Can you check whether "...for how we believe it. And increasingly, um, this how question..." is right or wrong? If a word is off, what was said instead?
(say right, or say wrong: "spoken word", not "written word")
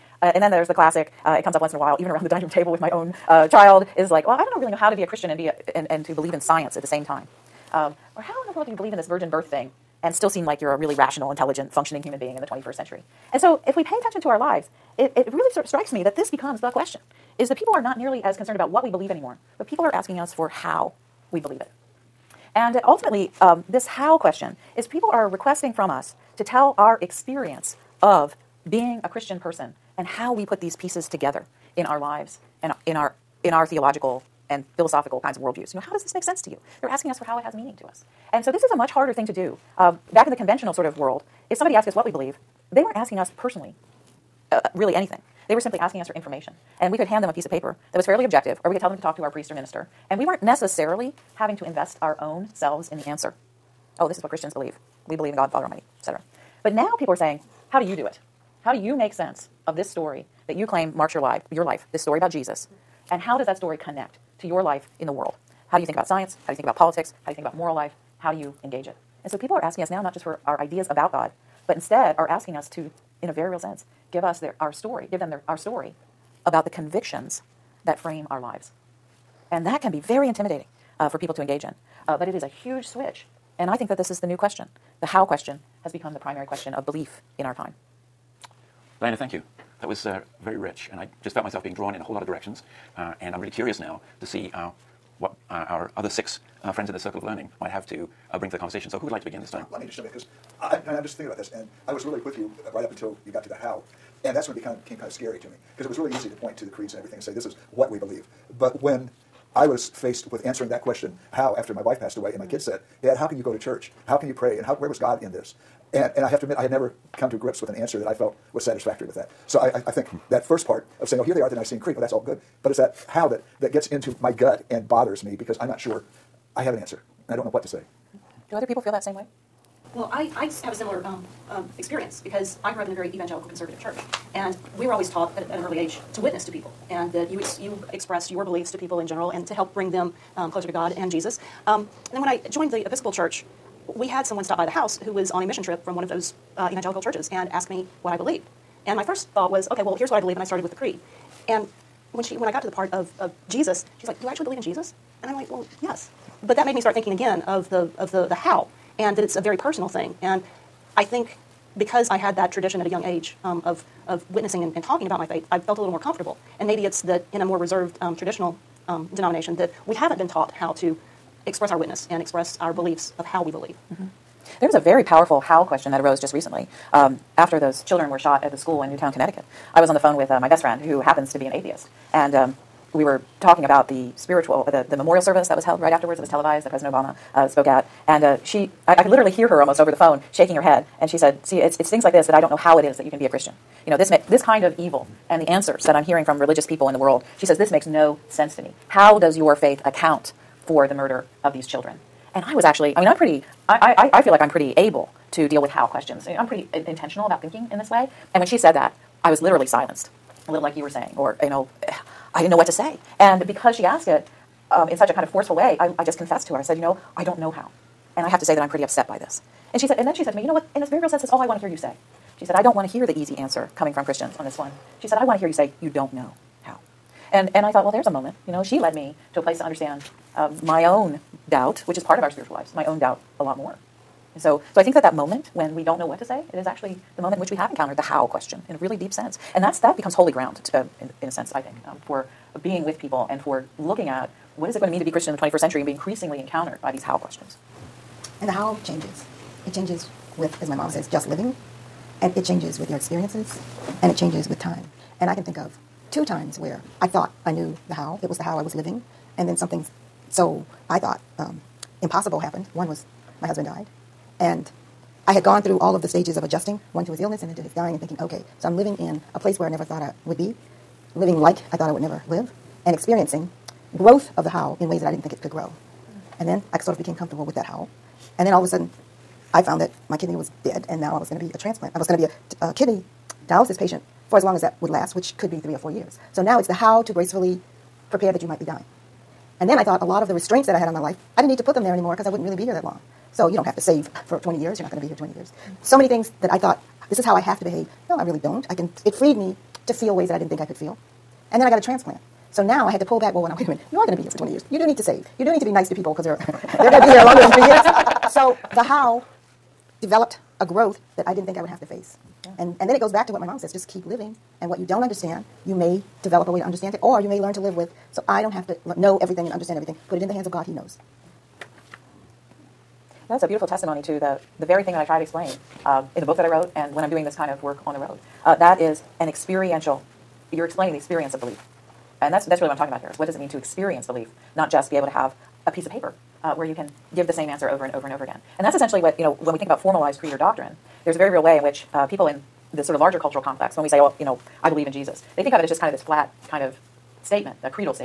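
wrong: "ultimately", not "increasingly".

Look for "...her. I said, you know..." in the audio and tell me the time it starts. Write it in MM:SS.
03:36.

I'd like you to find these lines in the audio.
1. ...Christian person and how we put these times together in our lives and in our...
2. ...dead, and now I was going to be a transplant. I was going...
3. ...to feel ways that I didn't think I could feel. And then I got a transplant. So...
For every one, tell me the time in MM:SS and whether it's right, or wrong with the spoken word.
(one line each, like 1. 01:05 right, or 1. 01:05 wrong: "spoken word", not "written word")
1. 00:29 wrong: "pieces", not "times"
2. 04:40 right
3. 04:59 right.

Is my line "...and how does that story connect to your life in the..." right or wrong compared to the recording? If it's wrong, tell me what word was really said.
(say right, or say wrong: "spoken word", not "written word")
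right.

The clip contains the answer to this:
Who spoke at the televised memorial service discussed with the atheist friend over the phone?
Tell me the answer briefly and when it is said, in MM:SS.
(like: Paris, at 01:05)
President Obama, at 03:06.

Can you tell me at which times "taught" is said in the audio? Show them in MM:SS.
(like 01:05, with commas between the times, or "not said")
02:15, 02:50.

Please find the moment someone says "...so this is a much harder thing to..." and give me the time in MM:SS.
00:38.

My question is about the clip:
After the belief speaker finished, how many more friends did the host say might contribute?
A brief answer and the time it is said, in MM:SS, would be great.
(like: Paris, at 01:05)
6, at 01:36.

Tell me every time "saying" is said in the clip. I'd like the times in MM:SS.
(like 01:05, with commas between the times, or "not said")
00:57, 02:01, 03:30.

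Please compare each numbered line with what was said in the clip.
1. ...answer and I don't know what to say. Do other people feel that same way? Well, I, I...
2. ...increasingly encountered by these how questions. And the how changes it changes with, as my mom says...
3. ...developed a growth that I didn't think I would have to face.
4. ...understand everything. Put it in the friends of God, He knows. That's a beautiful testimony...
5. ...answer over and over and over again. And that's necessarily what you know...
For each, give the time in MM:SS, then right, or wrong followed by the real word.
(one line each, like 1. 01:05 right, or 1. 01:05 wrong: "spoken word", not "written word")
1. 02:06 right
2. 04:05 right
3. 05:10 right
4. 05:19 wrong: "hands", not "friends"
5. 05:37 wrong: "essentially", not "necessarily".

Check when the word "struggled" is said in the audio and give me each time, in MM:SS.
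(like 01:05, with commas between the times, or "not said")
not said.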